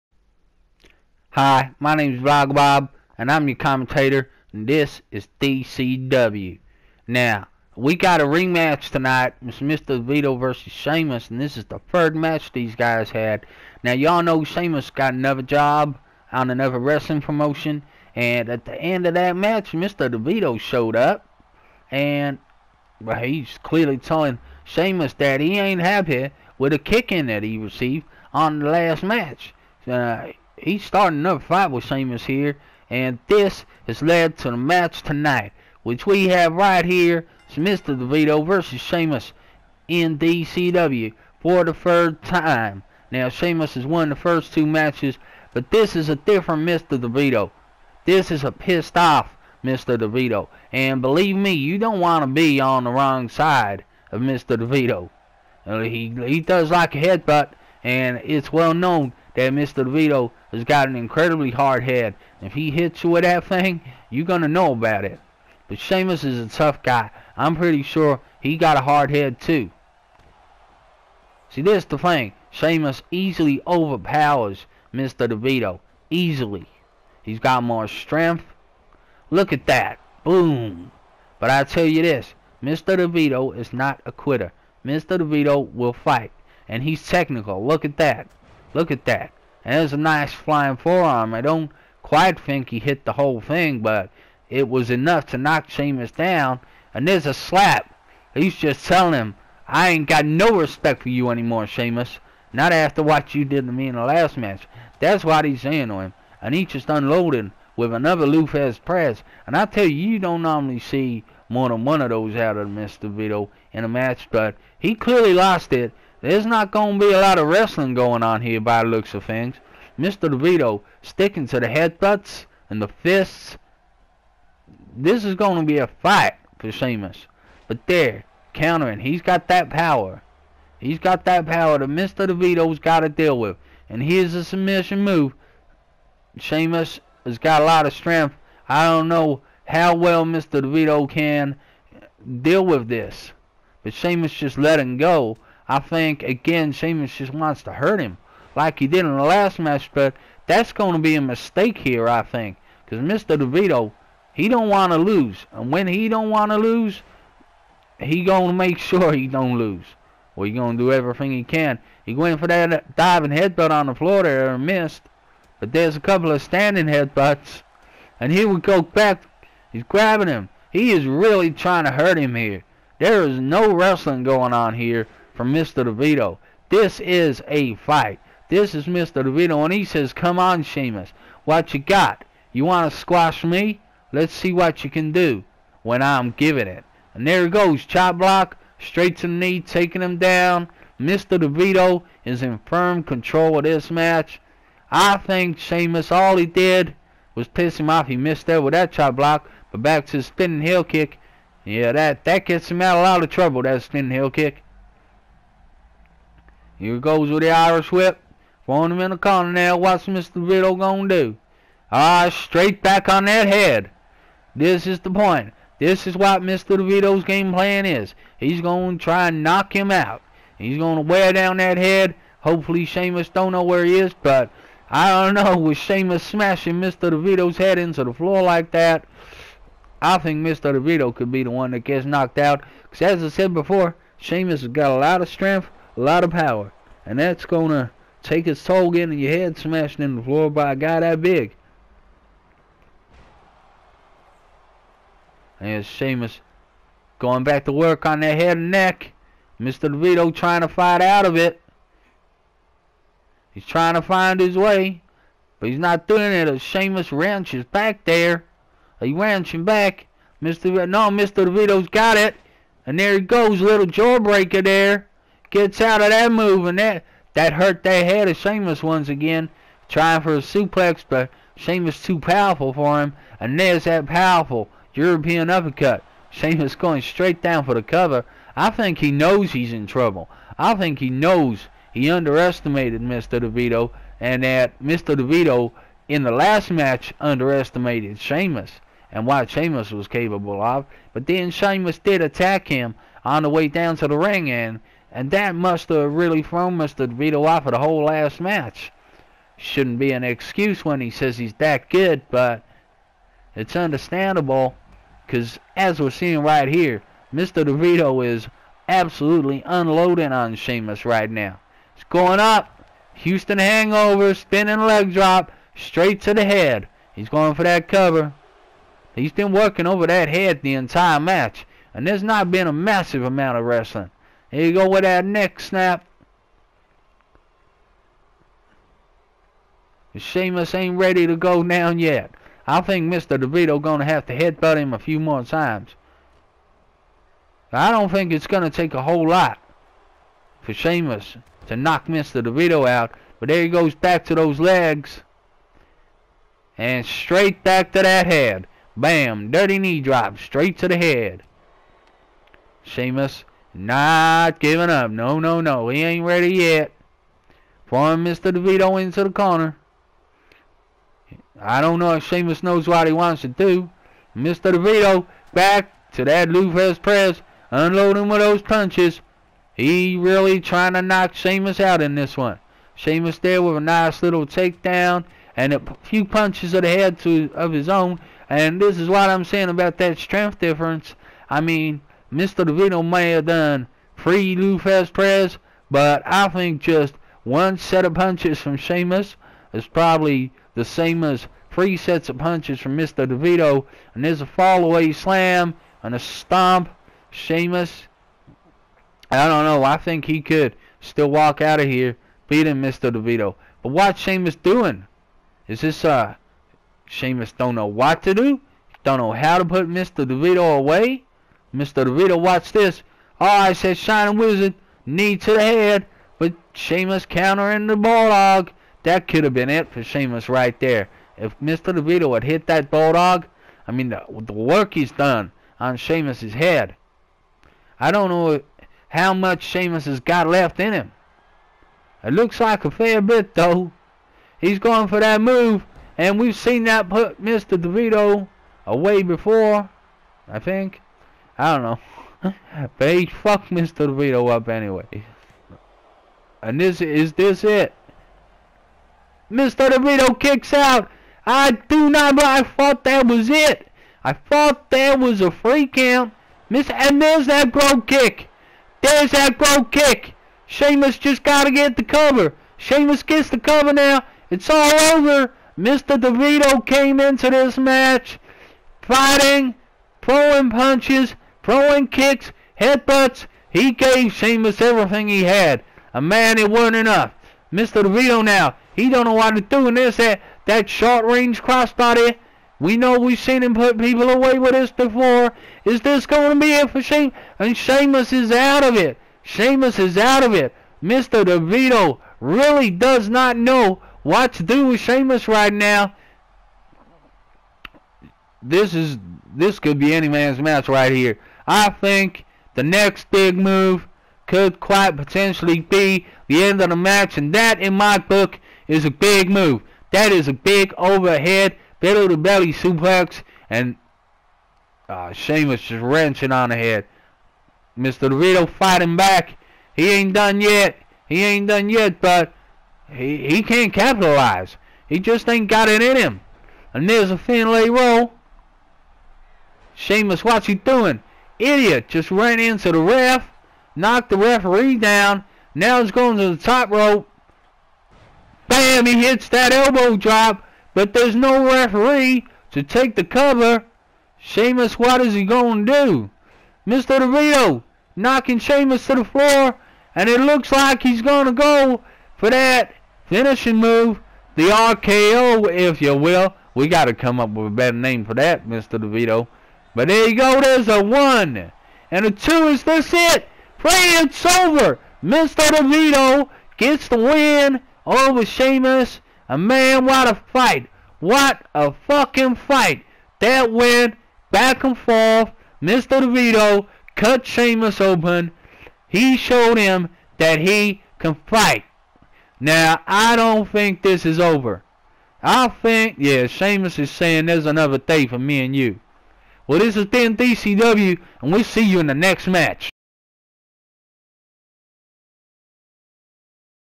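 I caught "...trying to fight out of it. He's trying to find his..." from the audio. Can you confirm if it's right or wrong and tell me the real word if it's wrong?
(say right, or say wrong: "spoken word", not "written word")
right.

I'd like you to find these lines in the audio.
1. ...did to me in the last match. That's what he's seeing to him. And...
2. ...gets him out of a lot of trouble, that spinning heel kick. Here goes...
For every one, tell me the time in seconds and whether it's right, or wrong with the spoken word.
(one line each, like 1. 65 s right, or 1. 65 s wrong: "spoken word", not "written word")
1. 103 s wrong: "saying", not "seeing"
2. 202 s right.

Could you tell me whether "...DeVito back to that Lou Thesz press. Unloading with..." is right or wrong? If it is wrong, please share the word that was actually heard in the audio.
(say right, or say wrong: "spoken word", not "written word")
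right.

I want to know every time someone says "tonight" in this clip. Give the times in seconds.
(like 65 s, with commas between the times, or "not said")
8 s, 35 s.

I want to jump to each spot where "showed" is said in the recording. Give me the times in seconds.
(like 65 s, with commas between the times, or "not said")
20 s, 579 s.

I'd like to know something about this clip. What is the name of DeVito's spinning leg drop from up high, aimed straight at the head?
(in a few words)
Houston hangover.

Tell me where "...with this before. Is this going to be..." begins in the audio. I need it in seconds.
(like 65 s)
484 s.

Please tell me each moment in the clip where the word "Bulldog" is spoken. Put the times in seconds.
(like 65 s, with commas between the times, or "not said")
417 s, 422 s.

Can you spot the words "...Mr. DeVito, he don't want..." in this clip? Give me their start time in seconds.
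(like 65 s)
153 s.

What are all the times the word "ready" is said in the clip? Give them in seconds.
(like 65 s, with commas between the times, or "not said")
330 s, 356 s.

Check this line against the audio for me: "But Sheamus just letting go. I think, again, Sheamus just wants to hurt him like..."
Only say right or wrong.
right.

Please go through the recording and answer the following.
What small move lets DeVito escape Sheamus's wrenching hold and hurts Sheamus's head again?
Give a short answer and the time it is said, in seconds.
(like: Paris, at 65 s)
Jawbreaker, at 263 s.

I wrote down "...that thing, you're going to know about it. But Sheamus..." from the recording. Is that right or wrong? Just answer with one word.
right.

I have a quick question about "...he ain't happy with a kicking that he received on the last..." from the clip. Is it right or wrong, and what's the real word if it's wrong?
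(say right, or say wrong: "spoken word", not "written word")
right.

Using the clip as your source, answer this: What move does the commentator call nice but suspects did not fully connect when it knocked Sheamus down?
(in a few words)
Flying forearm.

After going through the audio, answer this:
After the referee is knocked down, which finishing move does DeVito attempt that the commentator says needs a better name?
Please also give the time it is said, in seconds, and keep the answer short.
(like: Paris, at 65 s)
RKO, at 554 s.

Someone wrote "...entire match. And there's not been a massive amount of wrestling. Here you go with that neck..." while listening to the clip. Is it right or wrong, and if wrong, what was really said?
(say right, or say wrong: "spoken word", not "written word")
right.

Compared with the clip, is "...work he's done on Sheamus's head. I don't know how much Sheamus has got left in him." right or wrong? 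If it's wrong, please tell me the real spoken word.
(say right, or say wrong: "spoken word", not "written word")
right.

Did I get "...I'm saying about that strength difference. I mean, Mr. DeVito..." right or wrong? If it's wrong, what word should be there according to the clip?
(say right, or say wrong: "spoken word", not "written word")
right.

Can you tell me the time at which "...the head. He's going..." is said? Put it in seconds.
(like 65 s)
316 s.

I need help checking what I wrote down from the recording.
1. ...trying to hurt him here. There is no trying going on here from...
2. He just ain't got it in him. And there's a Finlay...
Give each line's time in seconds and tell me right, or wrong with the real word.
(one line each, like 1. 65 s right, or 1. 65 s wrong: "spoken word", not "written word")
1. 171 s wrong: "wrestling", not "trying"
2. 525 s right.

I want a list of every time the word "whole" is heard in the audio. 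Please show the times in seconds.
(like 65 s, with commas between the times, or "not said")
93 s, 297 s, 339 s.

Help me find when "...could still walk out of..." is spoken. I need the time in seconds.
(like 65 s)
400 s.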